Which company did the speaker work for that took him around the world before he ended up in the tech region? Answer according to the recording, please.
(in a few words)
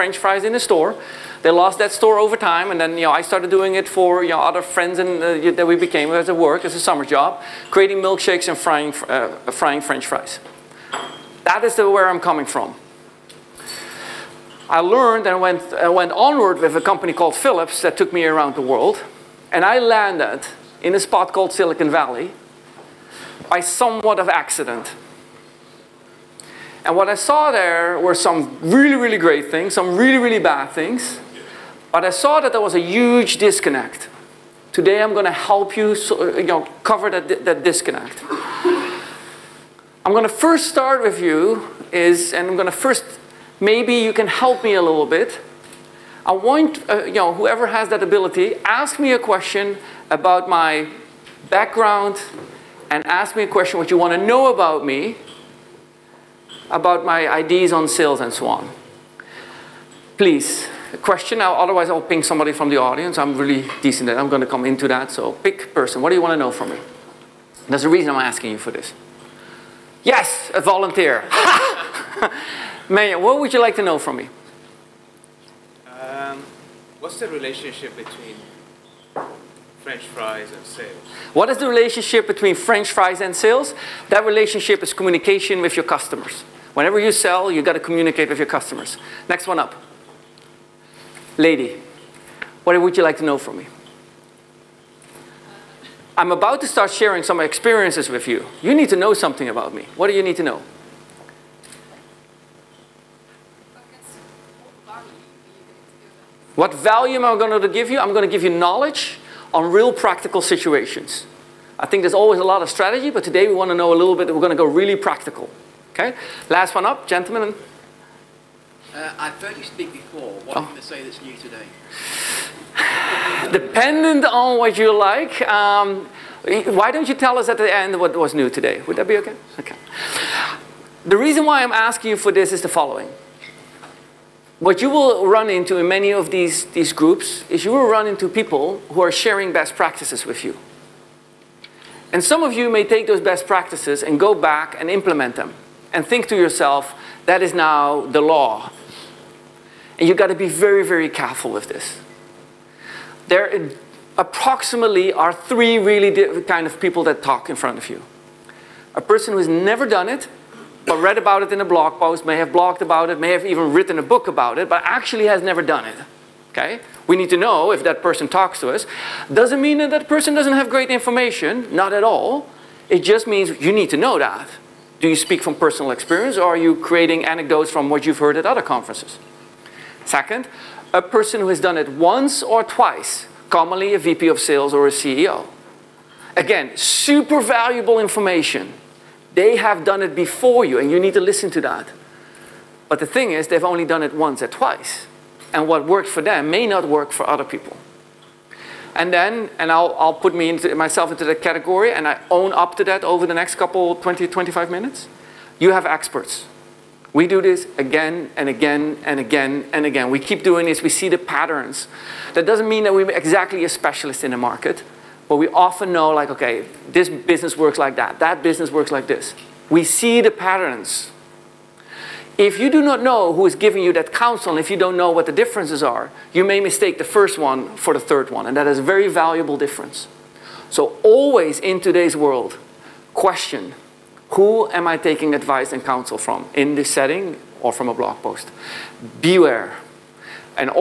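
Philips.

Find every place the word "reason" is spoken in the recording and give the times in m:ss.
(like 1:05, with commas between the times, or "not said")
1:07, 2:11.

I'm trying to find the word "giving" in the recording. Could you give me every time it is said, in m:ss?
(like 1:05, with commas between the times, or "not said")
3:43.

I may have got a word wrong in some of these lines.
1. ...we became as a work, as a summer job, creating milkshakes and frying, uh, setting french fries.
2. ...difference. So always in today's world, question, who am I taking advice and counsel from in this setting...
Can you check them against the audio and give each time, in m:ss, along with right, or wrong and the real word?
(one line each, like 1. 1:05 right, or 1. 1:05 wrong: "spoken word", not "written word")
1. 0:05 wrong: "frying", not "setting"
2. 3:49 right.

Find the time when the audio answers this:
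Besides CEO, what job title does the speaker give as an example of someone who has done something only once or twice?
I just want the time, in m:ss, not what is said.
3:03.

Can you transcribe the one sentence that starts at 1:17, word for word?
What's the relationship between French fries and sales?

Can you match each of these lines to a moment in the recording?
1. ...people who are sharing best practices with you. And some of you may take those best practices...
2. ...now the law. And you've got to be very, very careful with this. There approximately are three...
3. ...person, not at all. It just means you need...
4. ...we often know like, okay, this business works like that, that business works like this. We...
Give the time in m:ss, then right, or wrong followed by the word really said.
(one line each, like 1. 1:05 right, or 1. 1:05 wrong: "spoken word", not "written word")
1. 2:18 right
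2. 2:27 right
3. 2:50 wrong: "information", not "person"
4. 3:35 right.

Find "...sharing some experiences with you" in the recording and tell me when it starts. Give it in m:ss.
1:36.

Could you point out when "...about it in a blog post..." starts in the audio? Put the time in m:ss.
2:41.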